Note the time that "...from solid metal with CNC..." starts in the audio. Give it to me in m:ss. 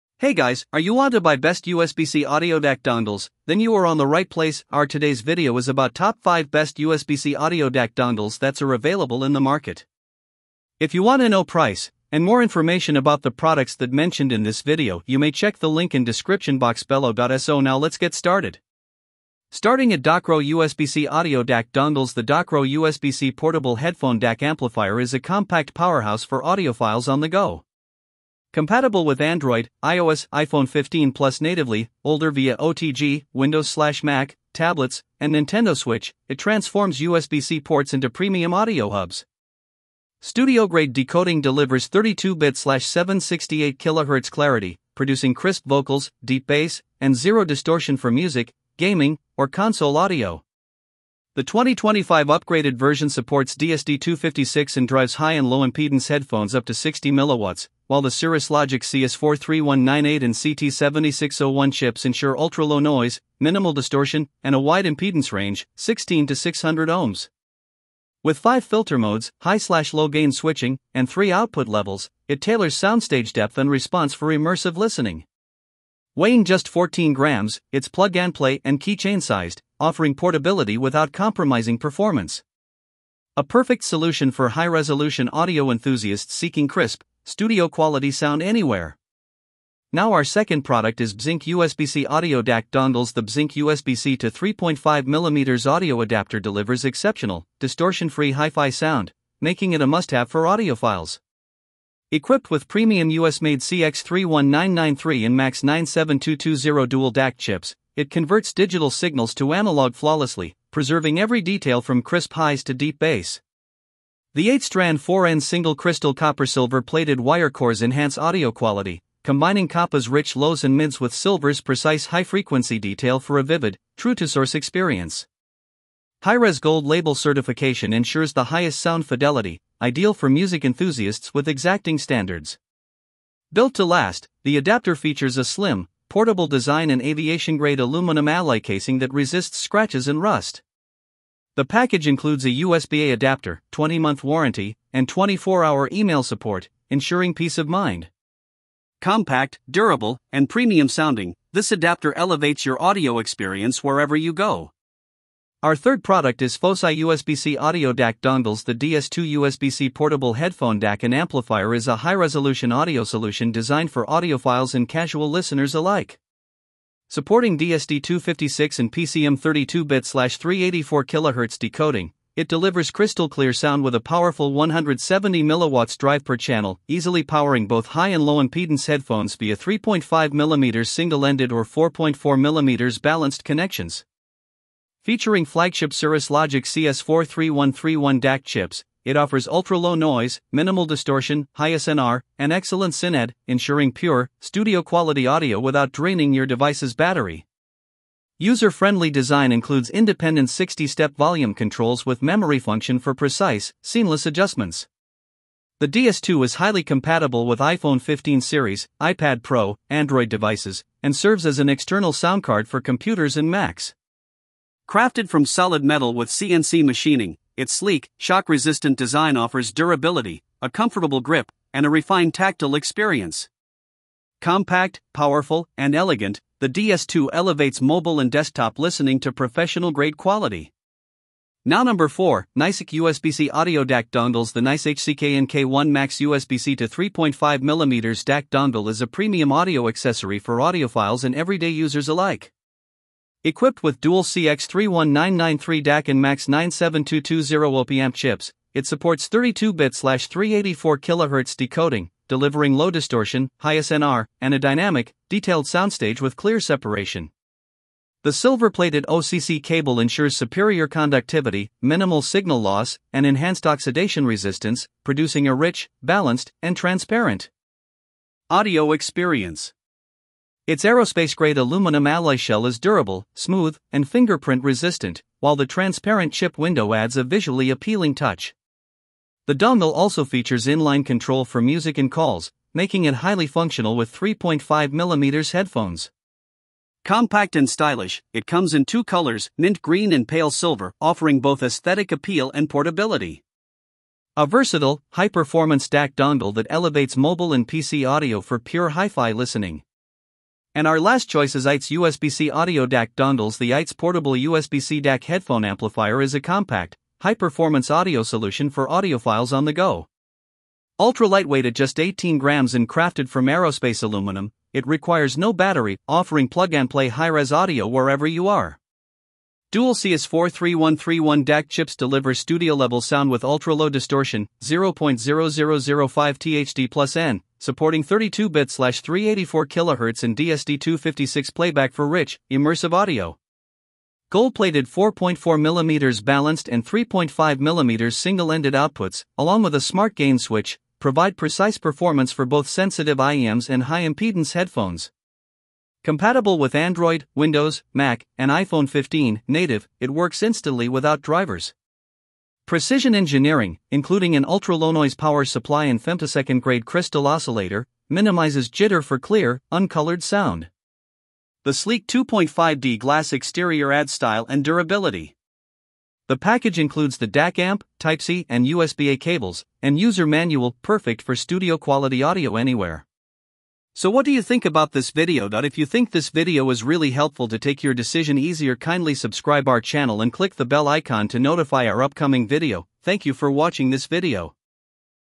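3:35.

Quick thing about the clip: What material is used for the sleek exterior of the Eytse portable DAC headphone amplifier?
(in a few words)
2.5D glass.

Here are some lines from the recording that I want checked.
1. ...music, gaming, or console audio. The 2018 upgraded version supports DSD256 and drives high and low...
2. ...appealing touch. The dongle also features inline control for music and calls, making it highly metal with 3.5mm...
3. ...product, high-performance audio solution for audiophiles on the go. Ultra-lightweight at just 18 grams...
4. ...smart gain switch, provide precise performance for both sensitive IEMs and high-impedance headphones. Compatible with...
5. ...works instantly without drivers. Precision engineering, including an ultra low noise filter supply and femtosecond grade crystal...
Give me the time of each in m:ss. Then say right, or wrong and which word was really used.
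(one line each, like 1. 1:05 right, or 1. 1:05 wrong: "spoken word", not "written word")
1. 0:48 wrong: "2025", not "2018"
2. 4:37 wrong: "functional", not "metal"
3. 5:06 wrong: "compact", not "product"
4. 5:39 right
5. 5:50 wrong: "power", not "filter".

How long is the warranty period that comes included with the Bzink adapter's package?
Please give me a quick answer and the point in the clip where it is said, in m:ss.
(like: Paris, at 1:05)
20 months, at 2:23.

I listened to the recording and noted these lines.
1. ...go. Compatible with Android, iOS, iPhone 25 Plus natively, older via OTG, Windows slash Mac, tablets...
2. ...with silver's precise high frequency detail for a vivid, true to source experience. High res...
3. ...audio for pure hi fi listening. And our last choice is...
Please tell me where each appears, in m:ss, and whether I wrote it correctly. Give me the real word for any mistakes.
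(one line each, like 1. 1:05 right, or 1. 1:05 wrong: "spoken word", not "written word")
1. 0:27 wrong: "15", not "25"
2. 2:01 right
3. 4:58 right.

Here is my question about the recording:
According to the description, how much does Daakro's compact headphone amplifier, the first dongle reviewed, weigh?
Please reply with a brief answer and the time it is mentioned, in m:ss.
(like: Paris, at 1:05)
14 grams, at 1:16.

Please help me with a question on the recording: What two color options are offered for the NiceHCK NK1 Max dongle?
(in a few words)
Mint green and pale silver.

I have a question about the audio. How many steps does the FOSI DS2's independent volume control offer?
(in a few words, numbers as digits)
60.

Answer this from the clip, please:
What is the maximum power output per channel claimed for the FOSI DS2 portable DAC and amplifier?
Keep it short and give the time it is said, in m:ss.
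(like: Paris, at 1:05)
170 mW, at 2:54.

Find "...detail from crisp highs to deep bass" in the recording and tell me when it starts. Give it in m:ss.
1:51.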